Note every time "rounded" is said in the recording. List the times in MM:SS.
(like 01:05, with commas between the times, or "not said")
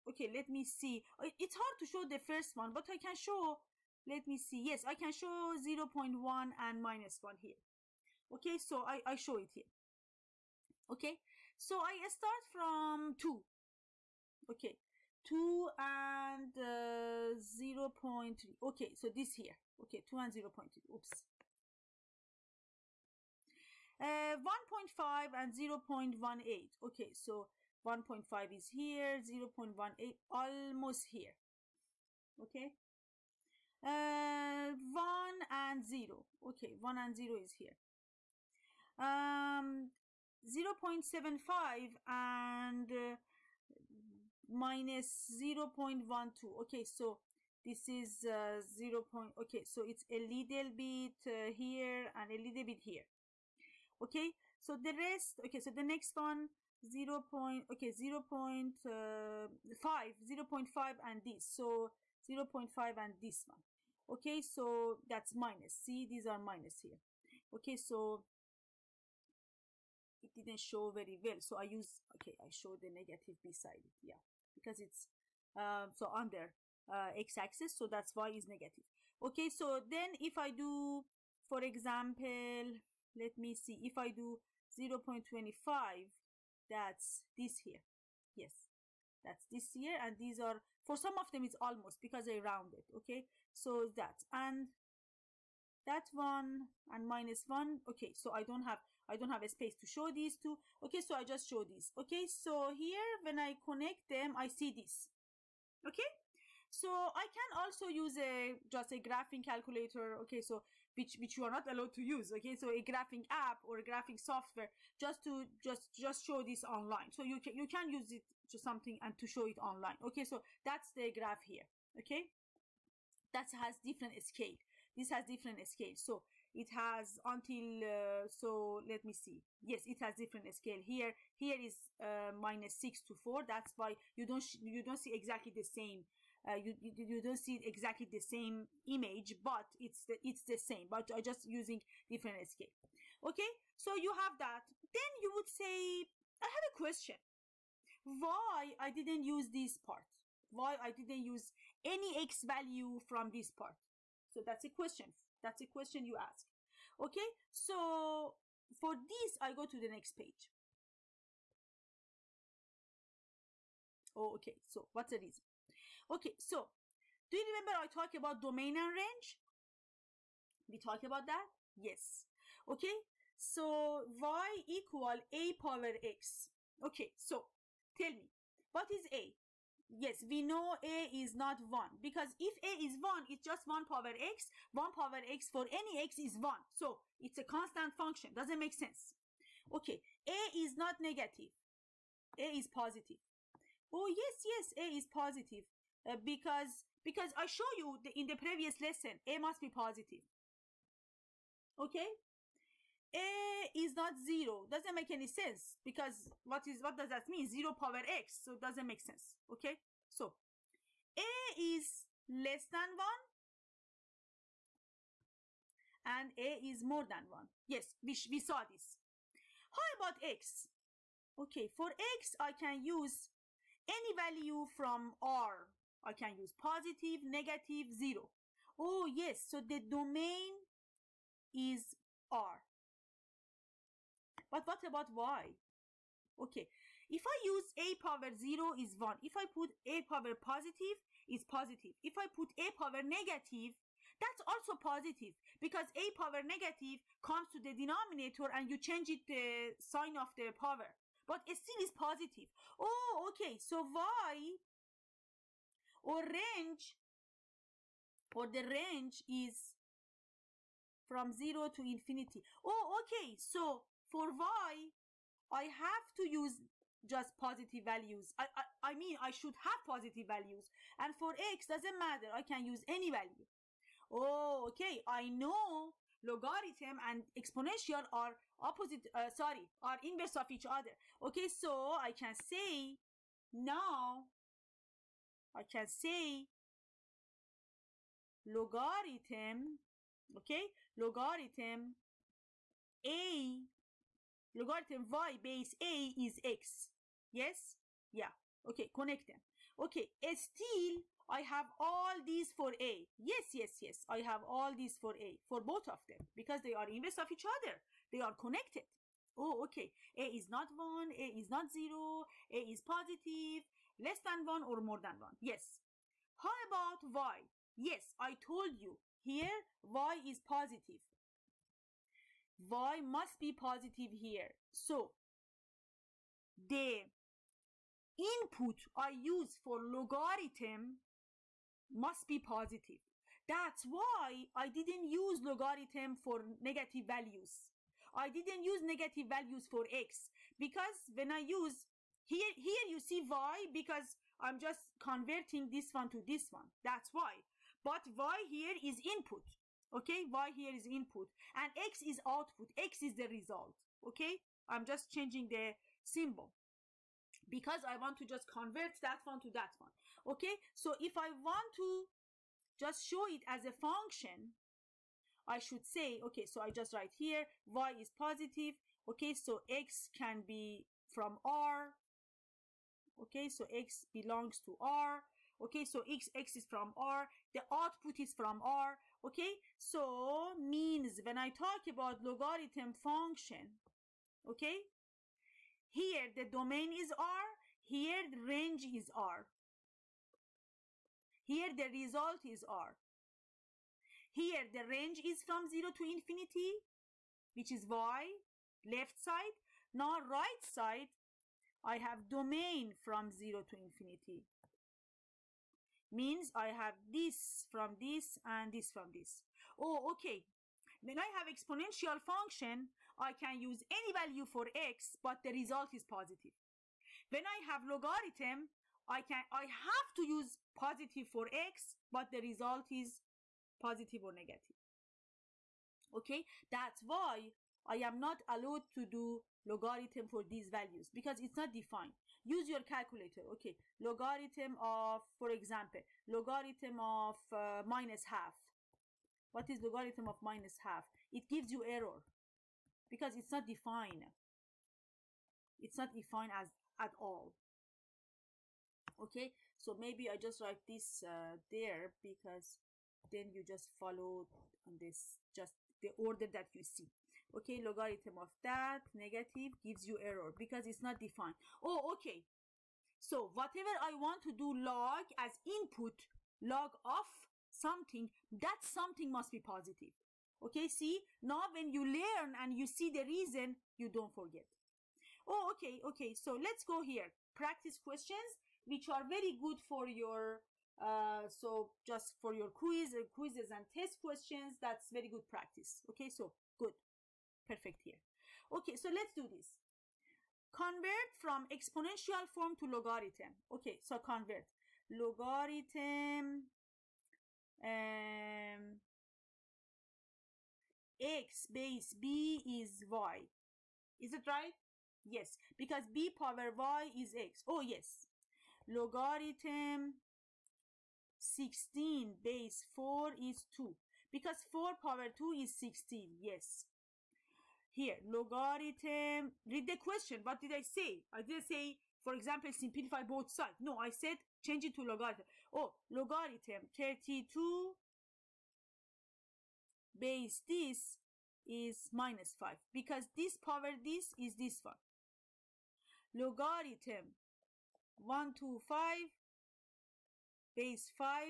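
01:32.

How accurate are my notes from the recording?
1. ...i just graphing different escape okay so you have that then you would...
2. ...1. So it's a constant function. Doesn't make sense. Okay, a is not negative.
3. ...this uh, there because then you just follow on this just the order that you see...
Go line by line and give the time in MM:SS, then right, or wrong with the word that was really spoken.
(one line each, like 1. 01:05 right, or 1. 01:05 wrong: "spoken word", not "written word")
1. 02:21 wrong: "using", not "graphing"
2. 03:06 right
3. 07:30 right.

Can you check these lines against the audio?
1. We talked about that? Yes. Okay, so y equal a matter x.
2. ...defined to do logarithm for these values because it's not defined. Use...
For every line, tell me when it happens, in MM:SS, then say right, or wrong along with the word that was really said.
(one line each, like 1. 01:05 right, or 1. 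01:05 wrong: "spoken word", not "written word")
1. 02:50 wrong: "power", not "matter"
2. 07:08 wrong: "allowed", not "defined".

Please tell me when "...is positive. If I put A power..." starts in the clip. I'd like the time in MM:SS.
04:01.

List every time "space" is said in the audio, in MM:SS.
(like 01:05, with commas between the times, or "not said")
01:39.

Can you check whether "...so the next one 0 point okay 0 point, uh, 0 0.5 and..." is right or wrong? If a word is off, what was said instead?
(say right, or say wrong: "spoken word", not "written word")
right.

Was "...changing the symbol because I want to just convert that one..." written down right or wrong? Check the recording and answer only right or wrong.
right.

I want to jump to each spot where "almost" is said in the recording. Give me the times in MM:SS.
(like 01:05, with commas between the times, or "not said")
00:30, 01:31.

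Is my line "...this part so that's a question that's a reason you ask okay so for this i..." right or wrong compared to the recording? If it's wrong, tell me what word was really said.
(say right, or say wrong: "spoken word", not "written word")
wrong: "question", not "reason".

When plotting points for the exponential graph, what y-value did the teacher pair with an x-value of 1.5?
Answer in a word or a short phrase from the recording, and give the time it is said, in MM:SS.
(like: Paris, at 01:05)
0.18, at 00:24.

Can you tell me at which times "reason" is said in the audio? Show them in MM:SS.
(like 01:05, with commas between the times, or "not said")
02:45, 07:53.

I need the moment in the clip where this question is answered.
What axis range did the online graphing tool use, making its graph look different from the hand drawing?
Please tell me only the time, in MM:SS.
02:12.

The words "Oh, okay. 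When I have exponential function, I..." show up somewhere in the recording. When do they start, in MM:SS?
06:49.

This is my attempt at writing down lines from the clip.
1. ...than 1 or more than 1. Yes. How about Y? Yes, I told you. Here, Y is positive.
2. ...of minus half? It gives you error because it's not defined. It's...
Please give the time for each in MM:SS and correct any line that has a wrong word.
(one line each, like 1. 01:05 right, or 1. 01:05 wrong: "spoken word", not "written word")
1. 05:14 right
2. 07:20 right.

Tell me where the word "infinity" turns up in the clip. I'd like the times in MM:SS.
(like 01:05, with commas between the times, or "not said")
04:21, 06:36, 06:43.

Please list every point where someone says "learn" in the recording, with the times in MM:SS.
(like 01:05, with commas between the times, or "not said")
07:52.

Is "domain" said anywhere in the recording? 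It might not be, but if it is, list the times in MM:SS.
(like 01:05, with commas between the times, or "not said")
02:48, 03:49, 06:26, 06:42.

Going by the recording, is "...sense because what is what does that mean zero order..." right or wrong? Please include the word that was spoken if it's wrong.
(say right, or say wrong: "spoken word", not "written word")
wrong: "power", not "order".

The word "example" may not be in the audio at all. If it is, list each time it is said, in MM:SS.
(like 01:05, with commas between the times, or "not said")
01:21, 07:15, 08:42.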